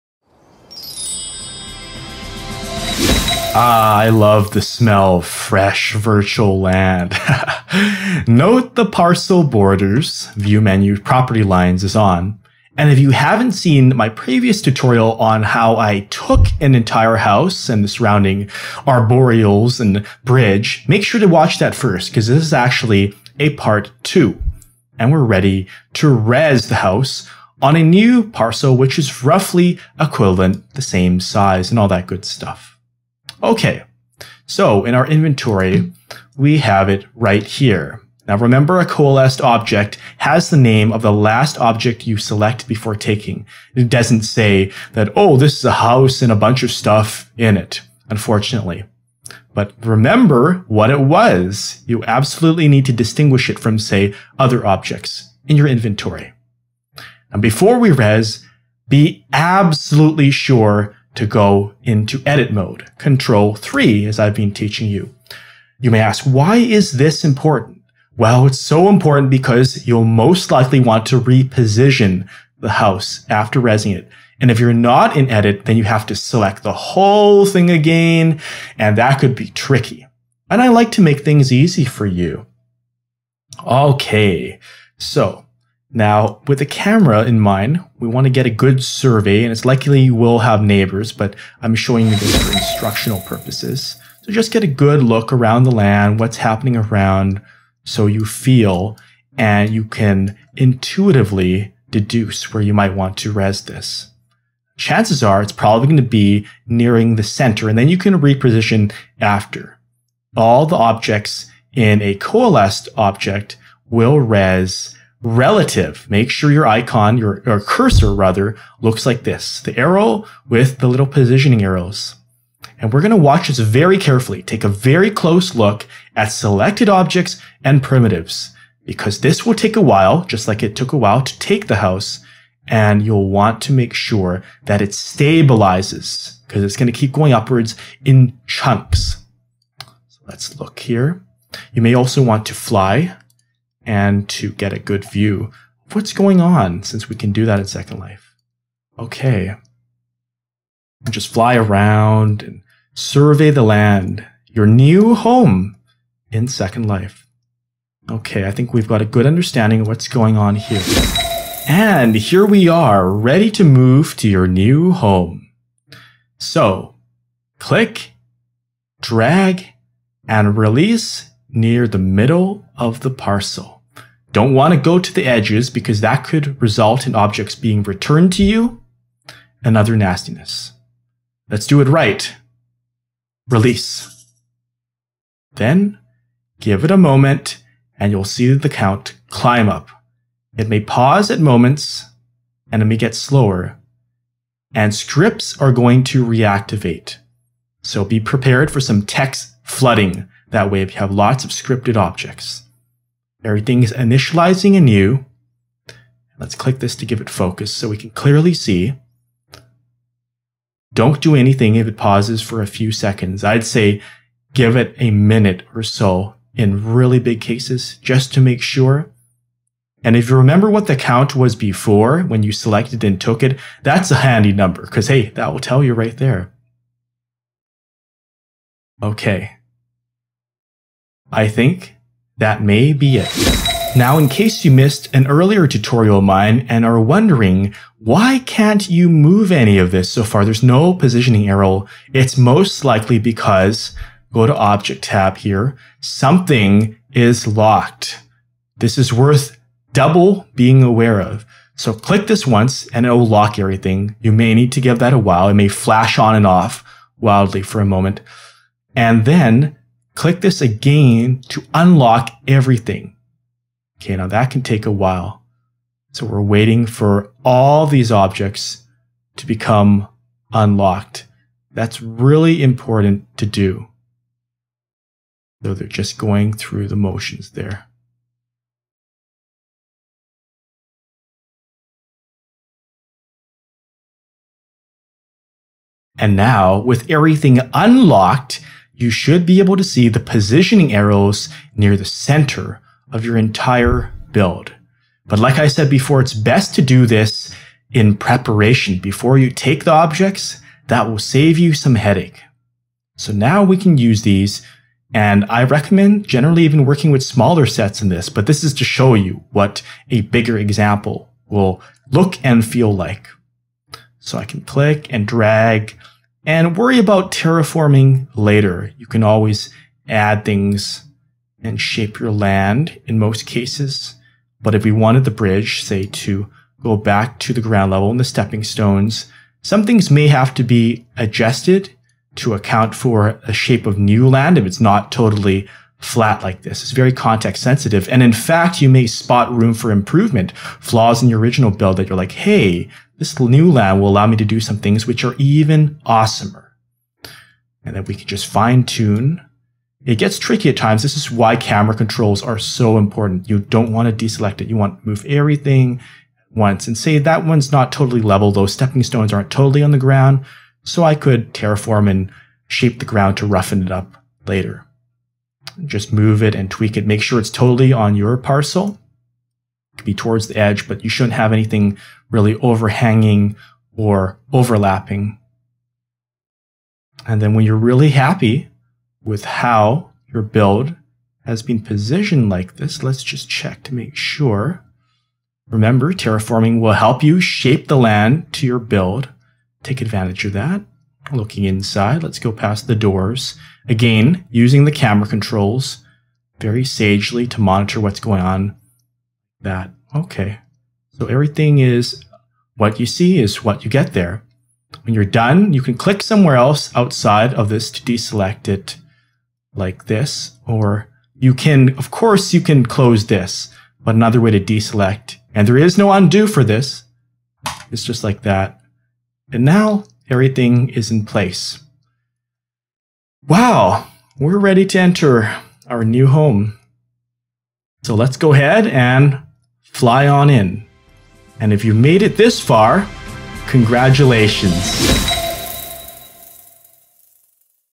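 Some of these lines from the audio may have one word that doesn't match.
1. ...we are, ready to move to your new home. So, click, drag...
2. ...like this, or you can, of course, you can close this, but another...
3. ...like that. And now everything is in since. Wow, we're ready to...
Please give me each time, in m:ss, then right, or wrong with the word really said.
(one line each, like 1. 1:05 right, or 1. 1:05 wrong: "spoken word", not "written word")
1. 2:42 right
2. 6:49 right
3. 6:58 wrong: "place", not "since".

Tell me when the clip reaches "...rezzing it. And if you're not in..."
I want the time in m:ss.
1:13.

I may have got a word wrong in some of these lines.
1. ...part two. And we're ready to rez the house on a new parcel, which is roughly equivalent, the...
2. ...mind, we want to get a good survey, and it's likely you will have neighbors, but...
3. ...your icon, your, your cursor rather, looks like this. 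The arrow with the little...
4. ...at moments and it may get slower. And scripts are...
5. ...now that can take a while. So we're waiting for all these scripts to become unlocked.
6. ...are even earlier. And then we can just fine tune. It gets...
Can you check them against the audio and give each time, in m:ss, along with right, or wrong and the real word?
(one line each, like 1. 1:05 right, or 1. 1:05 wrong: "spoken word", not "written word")
1. 0:23 right
2. 1:27 right
3. 1:56 right
4. 3:11 right
5. 4:24 wrong: "objects", not "scripts"
6. 5:45 wrong: "awesomer", not "earlier".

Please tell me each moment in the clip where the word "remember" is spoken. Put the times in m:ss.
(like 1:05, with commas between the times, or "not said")
0:38, 0:49, 3:40, 6:25.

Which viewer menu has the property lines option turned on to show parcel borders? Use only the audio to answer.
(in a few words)
View menu.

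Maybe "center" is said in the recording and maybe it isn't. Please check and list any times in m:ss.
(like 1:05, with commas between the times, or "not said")
1:47, 4:52.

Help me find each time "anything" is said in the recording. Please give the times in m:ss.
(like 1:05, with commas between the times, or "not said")
3:31, 6:11.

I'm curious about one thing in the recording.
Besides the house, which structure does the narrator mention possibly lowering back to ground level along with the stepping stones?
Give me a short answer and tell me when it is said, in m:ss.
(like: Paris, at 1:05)
the bridge, at 5:25.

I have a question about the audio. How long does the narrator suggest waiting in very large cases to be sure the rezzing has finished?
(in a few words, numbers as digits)
a minute.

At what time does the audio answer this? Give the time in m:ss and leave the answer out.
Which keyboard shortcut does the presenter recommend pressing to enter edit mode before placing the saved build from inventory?
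1:02.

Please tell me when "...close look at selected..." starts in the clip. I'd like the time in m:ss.
2:05.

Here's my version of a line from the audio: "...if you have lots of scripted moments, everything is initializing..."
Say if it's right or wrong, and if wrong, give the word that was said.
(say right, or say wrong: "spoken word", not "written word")
wrong: "objects", not "moments".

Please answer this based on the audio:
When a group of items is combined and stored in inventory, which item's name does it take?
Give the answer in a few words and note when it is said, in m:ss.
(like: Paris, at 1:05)
the last object you select, at 0:41.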